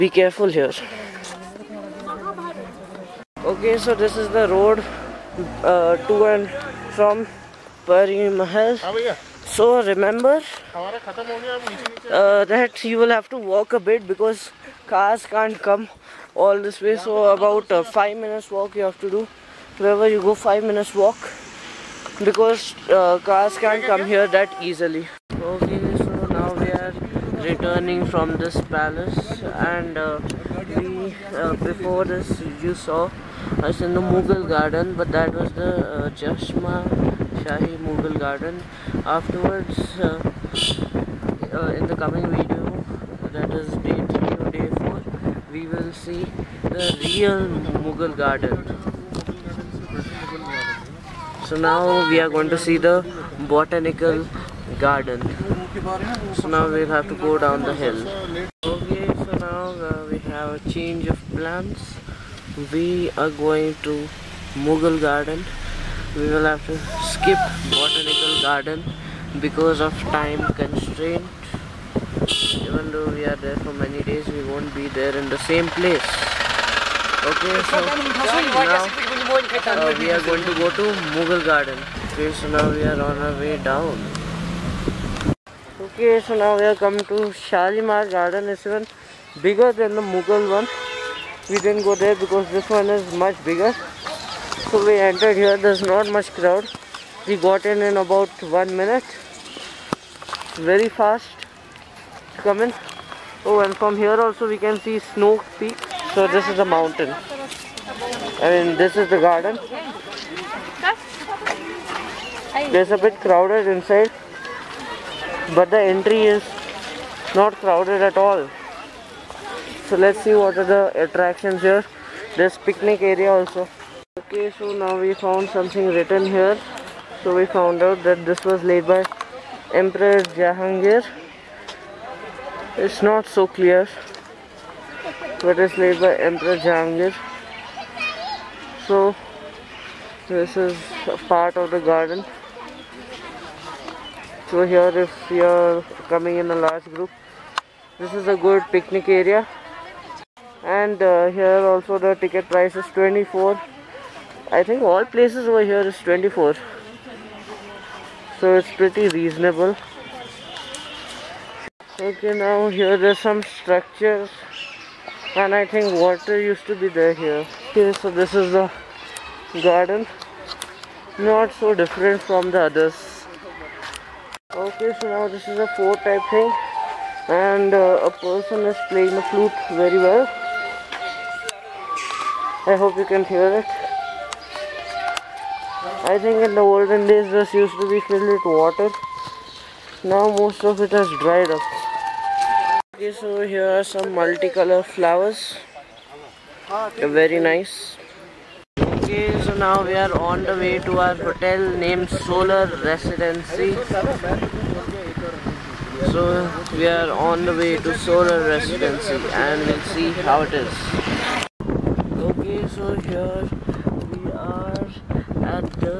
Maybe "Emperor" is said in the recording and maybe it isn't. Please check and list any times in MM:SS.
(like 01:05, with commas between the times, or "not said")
02:09, 02:16.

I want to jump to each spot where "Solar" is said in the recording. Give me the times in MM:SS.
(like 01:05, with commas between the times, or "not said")
03:22, 03:27.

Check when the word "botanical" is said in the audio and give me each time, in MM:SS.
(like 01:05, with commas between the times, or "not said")
00:53, 01:07.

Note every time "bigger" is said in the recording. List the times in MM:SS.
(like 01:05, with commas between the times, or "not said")
01:29, 01:33.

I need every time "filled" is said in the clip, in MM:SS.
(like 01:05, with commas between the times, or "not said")
03:08.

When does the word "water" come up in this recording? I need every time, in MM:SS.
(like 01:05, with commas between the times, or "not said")
02:45, 03:08.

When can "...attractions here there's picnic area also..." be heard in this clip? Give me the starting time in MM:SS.
02:01.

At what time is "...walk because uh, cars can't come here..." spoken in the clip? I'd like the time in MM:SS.
00:20.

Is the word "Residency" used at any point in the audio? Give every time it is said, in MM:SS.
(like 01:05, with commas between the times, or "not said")
03:22, 03:28.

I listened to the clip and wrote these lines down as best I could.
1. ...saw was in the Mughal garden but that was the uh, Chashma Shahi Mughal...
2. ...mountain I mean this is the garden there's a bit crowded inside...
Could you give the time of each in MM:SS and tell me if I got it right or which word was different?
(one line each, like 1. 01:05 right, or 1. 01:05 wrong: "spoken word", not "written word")
1. 00:32 right
2. 01:46 right.